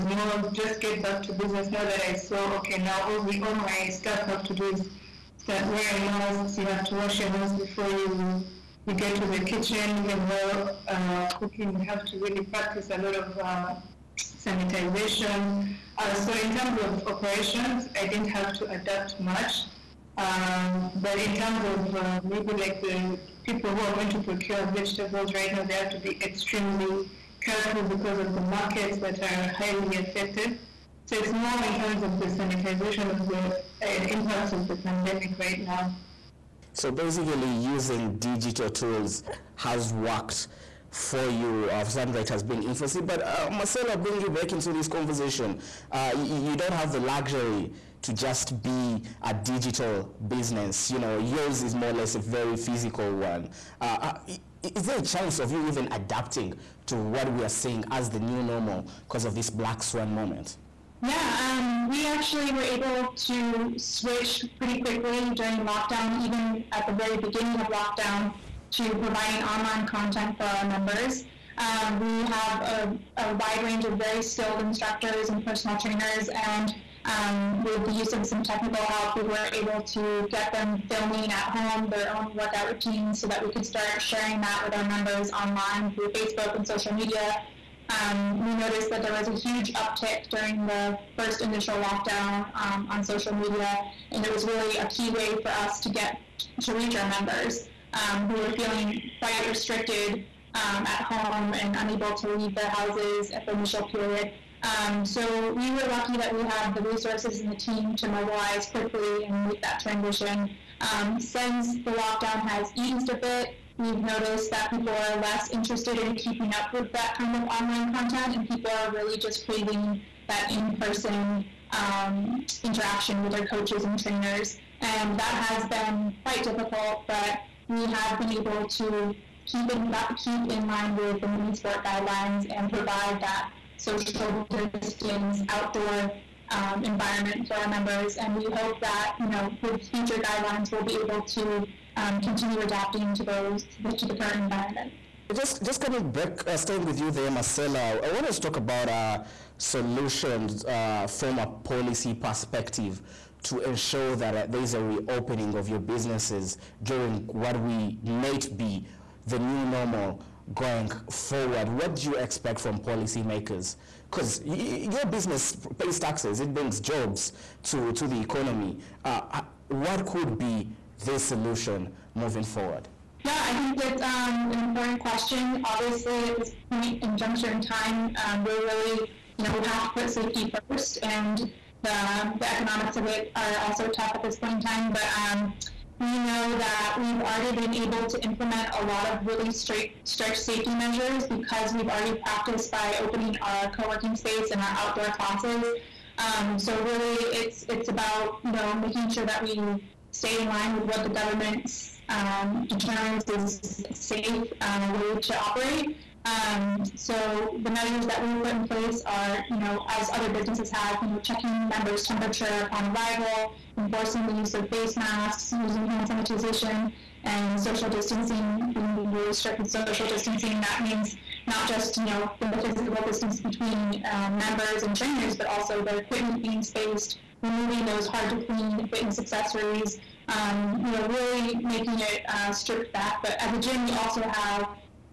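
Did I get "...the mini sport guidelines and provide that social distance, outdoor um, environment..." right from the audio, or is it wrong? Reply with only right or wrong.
right.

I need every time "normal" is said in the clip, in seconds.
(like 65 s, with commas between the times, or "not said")
58 s, 159 s.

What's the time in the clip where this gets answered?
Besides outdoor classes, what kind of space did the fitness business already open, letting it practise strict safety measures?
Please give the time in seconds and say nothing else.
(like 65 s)
193 s.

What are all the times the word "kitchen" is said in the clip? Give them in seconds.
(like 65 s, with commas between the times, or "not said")
9 s.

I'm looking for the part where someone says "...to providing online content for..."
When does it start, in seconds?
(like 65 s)
68 s.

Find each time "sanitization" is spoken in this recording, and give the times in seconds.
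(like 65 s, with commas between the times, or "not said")
14 s, 32 s, 216 s.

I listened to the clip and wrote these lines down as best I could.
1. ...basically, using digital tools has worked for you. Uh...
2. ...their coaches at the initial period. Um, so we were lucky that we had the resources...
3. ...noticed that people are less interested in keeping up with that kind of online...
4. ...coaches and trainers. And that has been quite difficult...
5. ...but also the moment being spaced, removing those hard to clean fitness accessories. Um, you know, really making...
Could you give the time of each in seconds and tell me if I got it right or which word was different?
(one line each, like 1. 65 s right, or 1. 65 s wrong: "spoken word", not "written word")
1. 36 s right
2. 102 s wrong: "houses", not "coaches"
3. 114 s right
4. 123 s right
5. 225 s wrong: "equipment", not "moment".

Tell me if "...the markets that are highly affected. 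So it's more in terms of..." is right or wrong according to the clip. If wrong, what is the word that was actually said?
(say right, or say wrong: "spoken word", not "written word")
right.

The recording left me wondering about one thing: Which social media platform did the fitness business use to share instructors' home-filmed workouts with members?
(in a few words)
Facebook.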